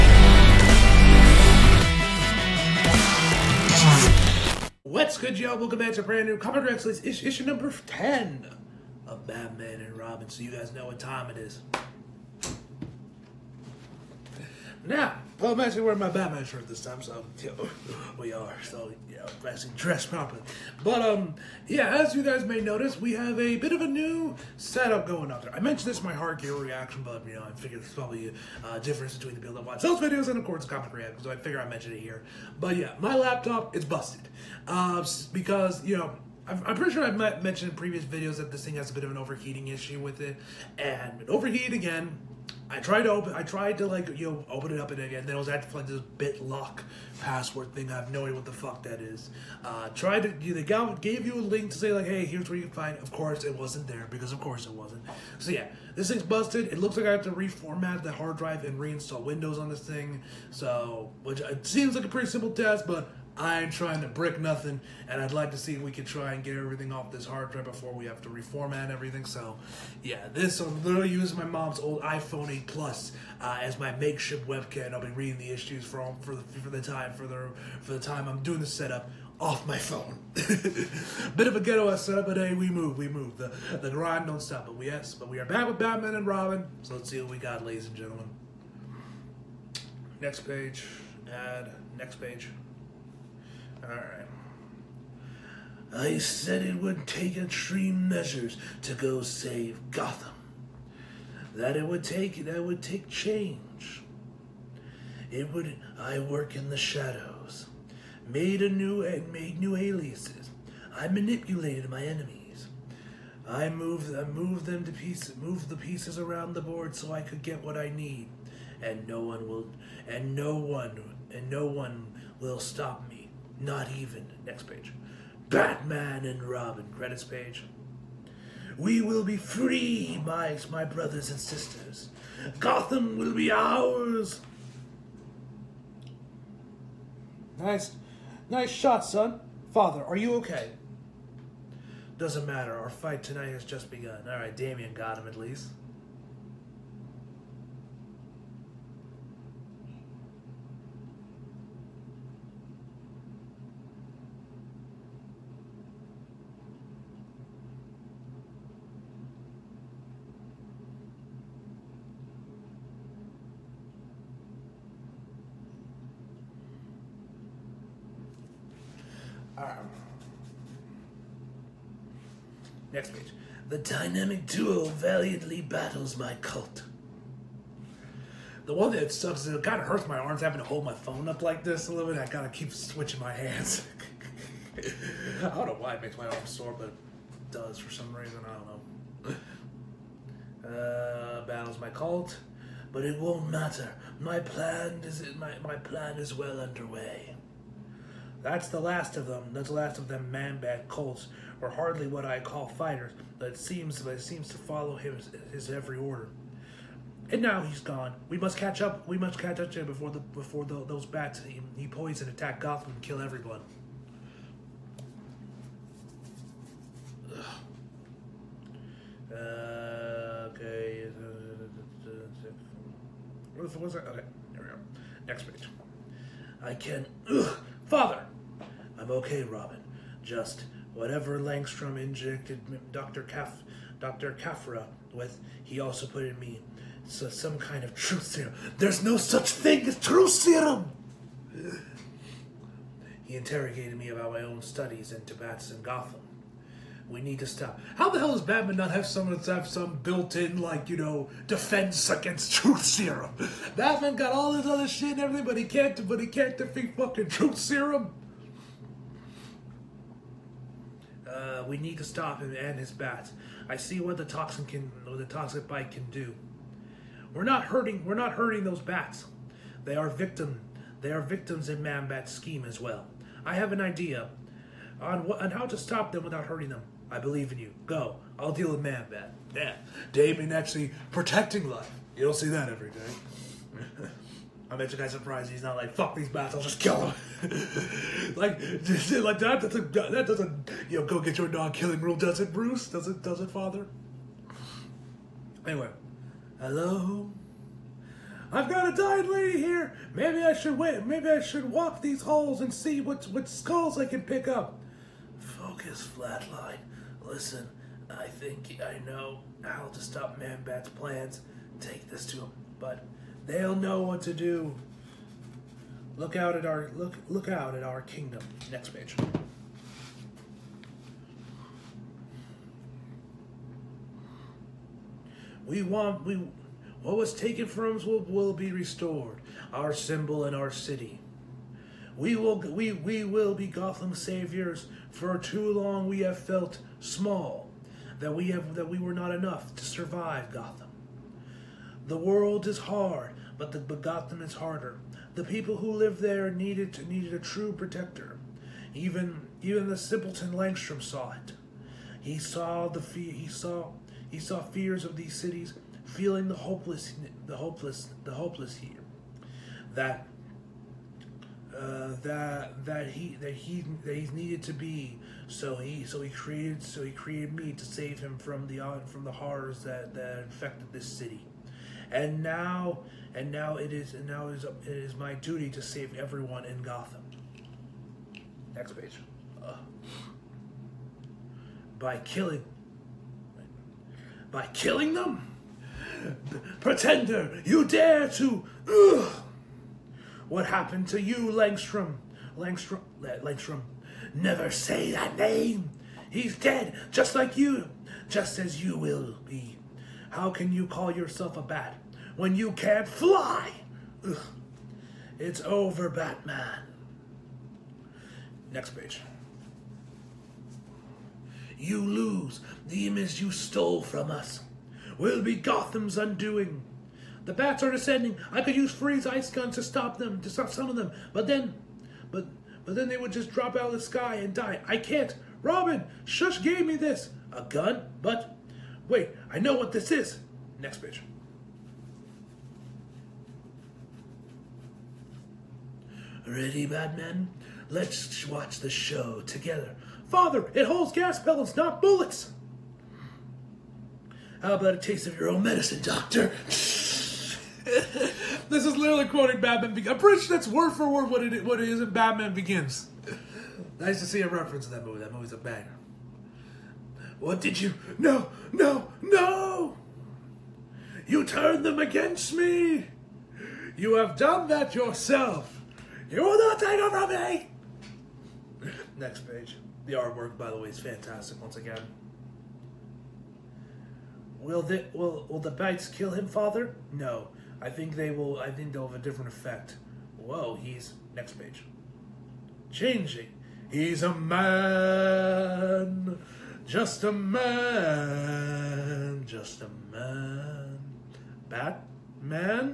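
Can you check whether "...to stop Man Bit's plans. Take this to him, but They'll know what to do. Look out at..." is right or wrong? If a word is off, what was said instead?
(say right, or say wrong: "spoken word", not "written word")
wrong: "Bat", not "Bit".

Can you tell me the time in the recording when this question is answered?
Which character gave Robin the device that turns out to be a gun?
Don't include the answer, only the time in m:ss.
7:06.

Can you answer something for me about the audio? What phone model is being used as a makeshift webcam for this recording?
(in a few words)
iPhone 8 Plus.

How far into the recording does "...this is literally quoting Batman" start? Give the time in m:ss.
7:26.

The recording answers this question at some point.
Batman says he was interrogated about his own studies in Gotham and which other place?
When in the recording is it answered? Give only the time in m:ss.
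4:05.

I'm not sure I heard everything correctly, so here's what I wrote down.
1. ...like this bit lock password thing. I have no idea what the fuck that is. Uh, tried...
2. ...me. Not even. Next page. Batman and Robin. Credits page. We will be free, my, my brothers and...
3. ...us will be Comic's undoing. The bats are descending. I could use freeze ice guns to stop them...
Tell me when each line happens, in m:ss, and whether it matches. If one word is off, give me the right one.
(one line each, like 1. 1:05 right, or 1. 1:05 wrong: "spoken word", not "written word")
1. 0:45 right
2. 2:03 right
3. 6:54 wrong: "Gotham", not "Comic".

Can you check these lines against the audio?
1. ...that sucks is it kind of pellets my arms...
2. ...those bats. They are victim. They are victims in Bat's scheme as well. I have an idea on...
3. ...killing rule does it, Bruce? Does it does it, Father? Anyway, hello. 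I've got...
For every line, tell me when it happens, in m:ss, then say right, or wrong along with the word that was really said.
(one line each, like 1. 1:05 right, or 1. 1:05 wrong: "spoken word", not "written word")
1. 2:58 wrong: "hurts", not "pellets"
2. 4:28 right
3. 4:51 right.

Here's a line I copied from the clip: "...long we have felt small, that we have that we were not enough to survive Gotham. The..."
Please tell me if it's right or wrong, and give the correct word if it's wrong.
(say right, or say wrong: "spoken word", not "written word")
right.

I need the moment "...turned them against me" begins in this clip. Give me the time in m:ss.
7:41.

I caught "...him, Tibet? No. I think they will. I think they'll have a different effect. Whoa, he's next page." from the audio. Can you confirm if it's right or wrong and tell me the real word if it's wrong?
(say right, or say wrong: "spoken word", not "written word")
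wrong: "Father", not "Tibet".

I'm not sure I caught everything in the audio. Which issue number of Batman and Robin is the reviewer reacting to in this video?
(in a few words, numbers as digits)
10.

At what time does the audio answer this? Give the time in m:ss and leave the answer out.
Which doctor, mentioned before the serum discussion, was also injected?
3:53.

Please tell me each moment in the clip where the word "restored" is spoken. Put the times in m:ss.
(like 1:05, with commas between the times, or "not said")
5:28.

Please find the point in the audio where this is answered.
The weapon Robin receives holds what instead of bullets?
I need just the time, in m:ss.
7:21.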